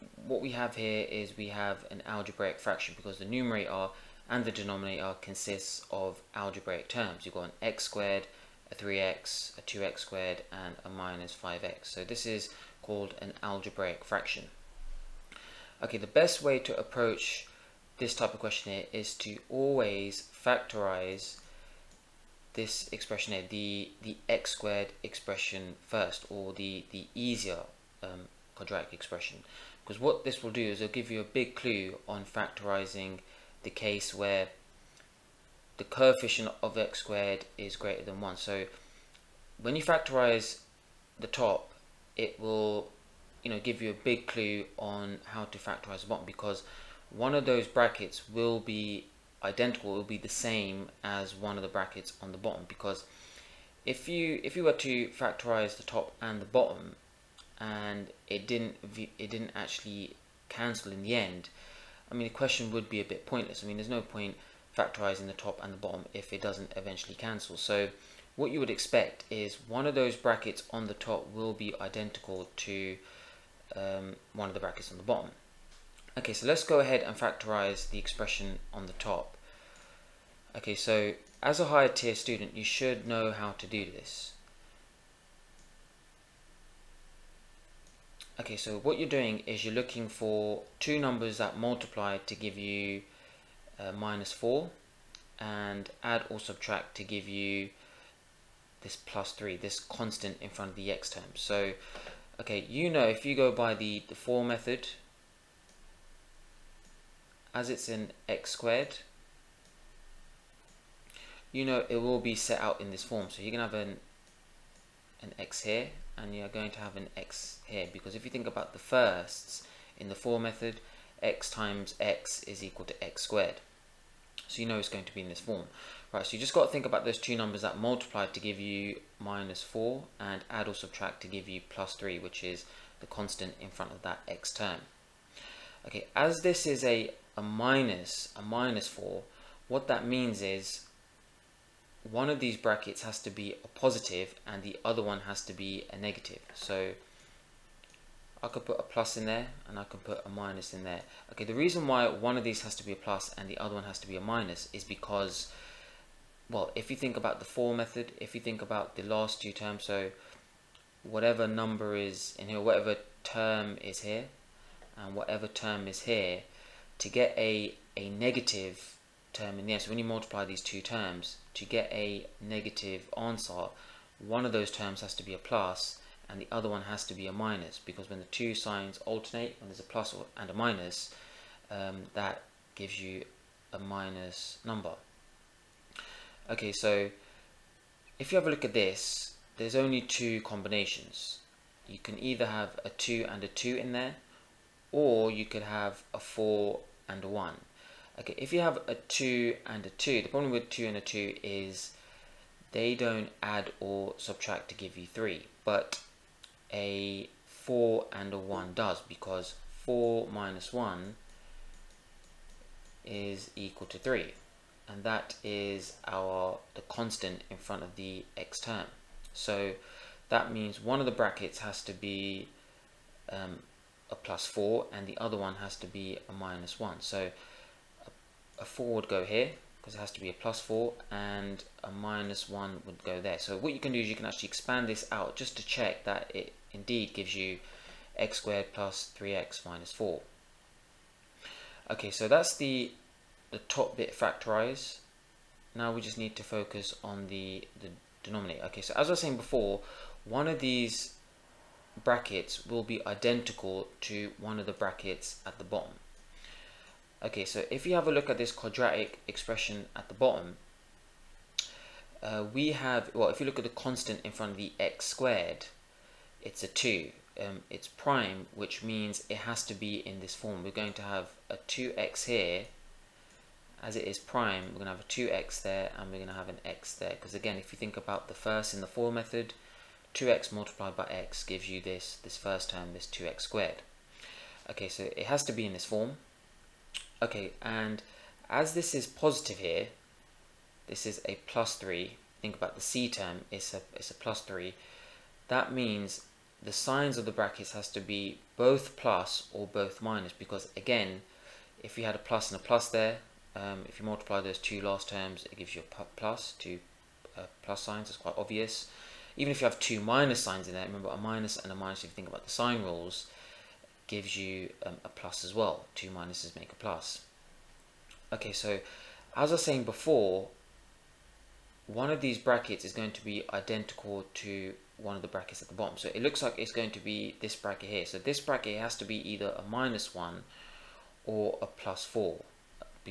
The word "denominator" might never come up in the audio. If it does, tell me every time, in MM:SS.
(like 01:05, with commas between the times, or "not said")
00:04, 04:08.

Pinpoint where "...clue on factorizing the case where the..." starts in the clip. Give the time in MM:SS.
00:31.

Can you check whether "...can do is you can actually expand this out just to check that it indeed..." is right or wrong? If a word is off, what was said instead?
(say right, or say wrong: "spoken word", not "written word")
right.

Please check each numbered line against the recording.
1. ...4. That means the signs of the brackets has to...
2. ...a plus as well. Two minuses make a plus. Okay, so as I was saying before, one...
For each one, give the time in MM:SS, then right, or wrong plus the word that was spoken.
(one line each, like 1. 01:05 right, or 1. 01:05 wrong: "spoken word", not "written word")
1. 04:54 wrong: "3", not "4"
2. 05:15 right.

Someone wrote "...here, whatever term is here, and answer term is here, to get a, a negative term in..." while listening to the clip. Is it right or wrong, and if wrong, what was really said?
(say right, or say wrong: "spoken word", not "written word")
wrong: "whatever", not "answer".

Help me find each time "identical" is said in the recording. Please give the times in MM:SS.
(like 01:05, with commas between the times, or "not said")
00:49, 01:11, 04:13, 05:23.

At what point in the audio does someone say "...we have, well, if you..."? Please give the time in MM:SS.
04:22.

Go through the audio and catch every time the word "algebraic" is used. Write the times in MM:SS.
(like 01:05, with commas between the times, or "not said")
00:02, 00:06, 00:13.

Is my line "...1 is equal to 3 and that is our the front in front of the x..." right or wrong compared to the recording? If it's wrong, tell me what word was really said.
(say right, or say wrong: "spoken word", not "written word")
wrong: "constant", not "front".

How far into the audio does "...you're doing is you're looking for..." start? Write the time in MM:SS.
01:28.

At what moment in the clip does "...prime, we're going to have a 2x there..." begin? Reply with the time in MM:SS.
04:34.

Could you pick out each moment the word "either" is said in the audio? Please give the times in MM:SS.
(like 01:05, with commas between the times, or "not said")
03:12, 05:29.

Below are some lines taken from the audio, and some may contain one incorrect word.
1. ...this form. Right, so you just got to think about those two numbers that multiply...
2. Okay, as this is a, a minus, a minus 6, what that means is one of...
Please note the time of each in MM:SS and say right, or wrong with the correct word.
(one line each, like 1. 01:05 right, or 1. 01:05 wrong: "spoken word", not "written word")
1. 02:05 right
2. 02:15 wrong: "4", not "6".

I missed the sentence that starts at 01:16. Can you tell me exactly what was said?
Okay, so let's go ahead and factorize the expression on the top.